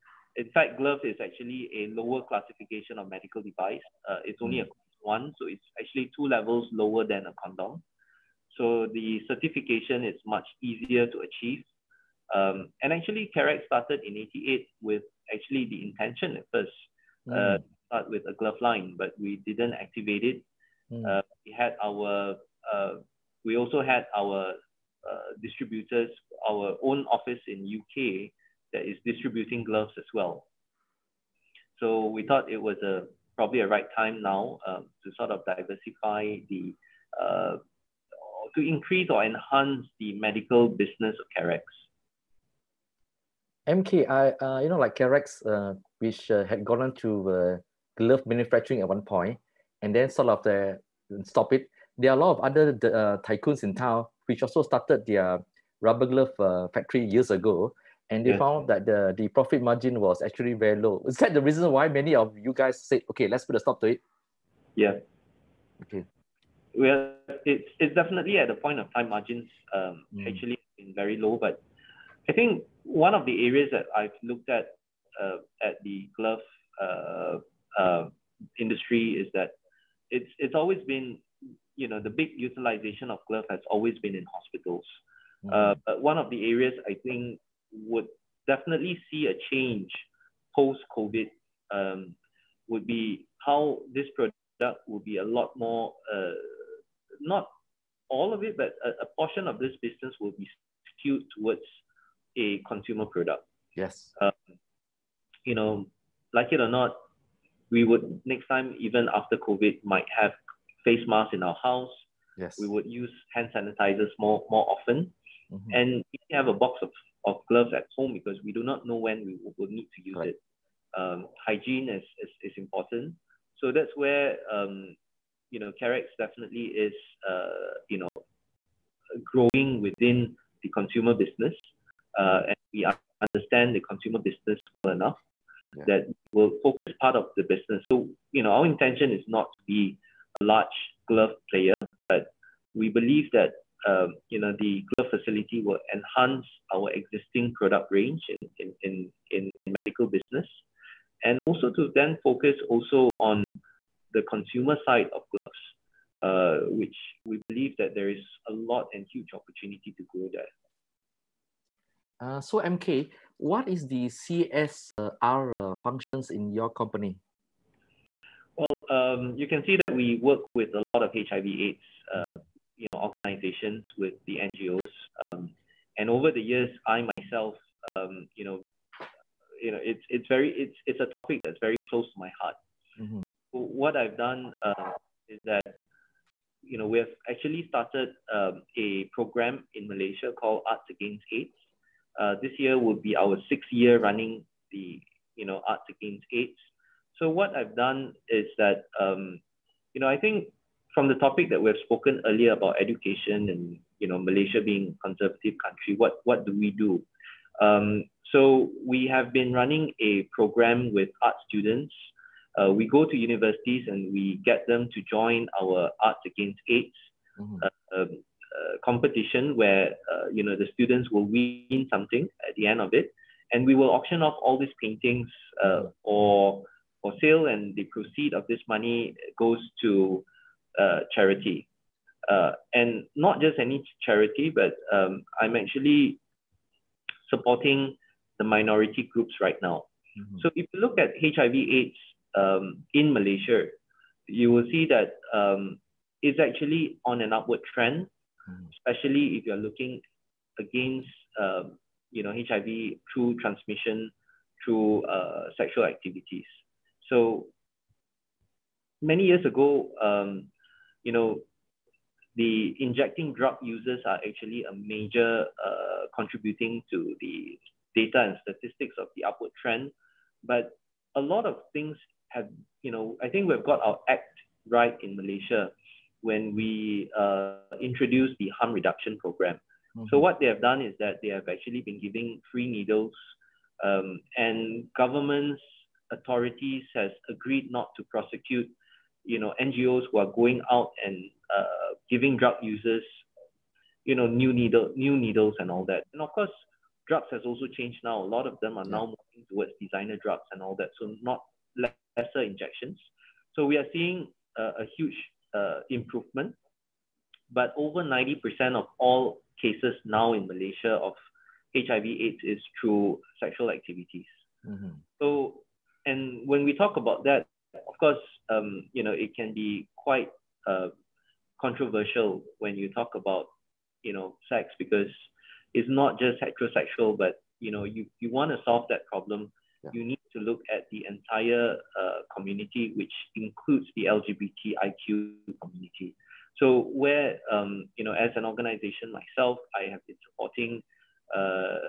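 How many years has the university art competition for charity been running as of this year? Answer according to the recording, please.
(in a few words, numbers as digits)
6.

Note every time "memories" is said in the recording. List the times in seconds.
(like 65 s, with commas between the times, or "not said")
not said.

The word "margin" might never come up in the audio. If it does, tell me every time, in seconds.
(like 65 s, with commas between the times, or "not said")
59 s, 69 s.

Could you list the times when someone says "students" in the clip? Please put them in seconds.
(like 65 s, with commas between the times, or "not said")
211 s, 220 s.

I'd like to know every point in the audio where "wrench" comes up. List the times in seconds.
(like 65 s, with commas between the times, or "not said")
not said.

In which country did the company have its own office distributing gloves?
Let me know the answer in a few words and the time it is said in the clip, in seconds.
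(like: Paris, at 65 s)
UK, at 27 s.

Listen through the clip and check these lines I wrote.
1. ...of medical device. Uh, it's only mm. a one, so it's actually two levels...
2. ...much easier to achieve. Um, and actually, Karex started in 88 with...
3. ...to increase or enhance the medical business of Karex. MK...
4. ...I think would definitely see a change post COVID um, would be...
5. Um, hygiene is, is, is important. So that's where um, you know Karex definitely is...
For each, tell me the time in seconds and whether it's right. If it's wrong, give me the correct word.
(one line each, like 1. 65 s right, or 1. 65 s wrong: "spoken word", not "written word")
1. 2 s right
2. 10 s right
3. 38 s right
4. 86 s right
5. 120 s right.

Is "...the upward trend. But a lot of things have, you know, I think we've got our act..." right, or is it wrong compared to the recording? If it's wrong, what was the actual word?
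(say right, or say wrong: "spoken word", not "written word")
right.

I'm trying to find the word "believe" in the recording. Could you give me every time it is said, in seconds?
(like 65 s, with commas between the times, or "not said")
142 s, 157 s.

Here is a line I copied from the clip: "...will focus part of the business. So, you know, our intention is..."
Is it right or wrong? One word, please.
right.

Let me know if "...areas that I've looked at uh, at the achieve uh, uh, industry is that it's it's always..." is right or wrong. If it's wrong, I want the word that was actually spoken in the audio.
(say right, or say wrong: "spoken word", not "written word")
wrong: "glove", not "achieve".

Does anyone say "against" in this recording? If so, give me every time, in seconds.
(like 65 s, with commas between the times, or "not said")
190 s, 195 s, 216 s, 250 s.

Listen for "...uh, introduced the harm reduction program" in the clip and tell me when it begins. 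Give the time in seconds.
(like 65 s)
277 s.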